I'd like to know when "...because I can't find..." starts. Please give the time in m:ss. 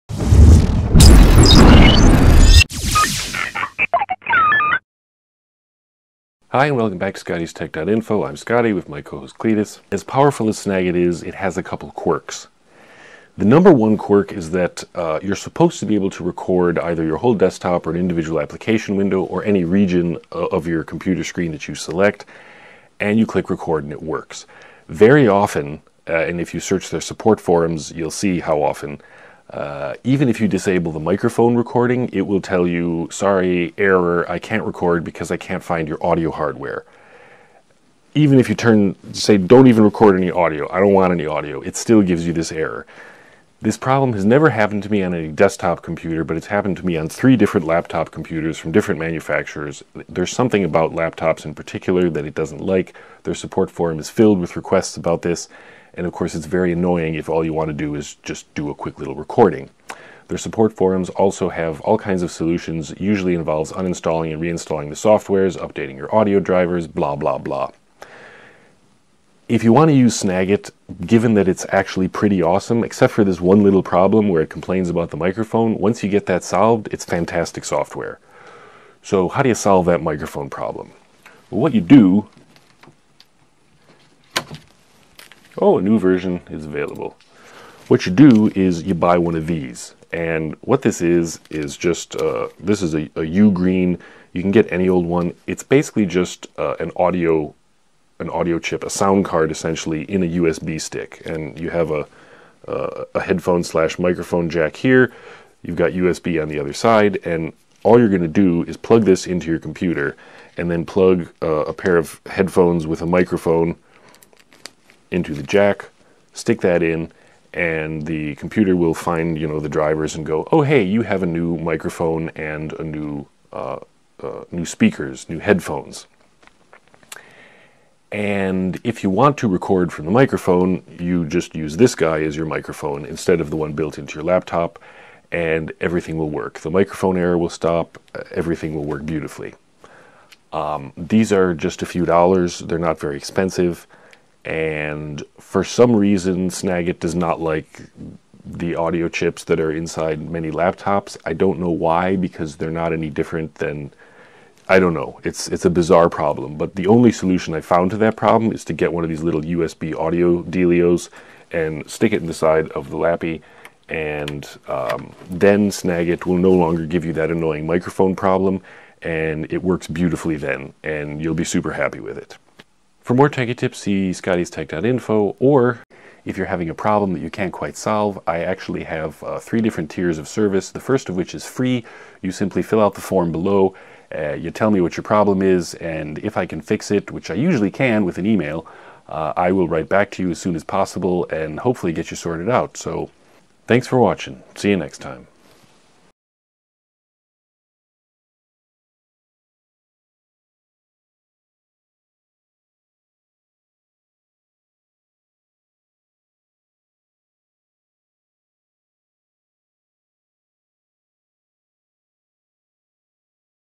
0:35.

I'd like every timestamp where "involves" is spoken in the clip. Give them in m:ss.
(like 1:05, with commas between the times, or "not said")
1:03.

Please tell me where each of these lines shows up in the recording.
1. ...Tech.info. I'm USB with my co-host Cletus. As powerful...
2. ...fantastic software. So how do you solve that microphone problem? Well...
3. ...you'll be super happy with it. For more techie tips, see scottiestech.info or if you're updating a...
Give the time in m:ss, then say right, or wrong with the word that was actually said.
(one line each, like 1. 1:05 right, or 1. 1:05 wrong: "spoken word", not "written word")
1. 0:07 wrong: "Scotty", not "USB"
2. 1:17 right
3. 2:51 wrong: "having", not "updating".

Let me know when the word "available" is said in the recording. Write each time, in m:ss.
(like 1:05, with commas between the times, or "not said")
1:26.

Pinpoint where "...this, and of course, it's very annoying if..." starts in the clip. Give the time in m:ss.
0:55.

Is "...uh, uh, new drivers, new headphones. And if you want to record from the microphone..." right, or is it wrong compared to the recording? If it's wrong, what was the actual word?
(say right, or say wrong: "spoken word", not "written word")
wrong: "speakers", not "drivers".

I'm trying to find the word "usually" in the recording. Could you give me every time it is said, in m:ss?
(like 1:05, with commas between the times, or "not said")
1:02, 3:07.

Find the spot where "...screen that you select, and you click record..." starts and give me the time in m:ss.
0:21.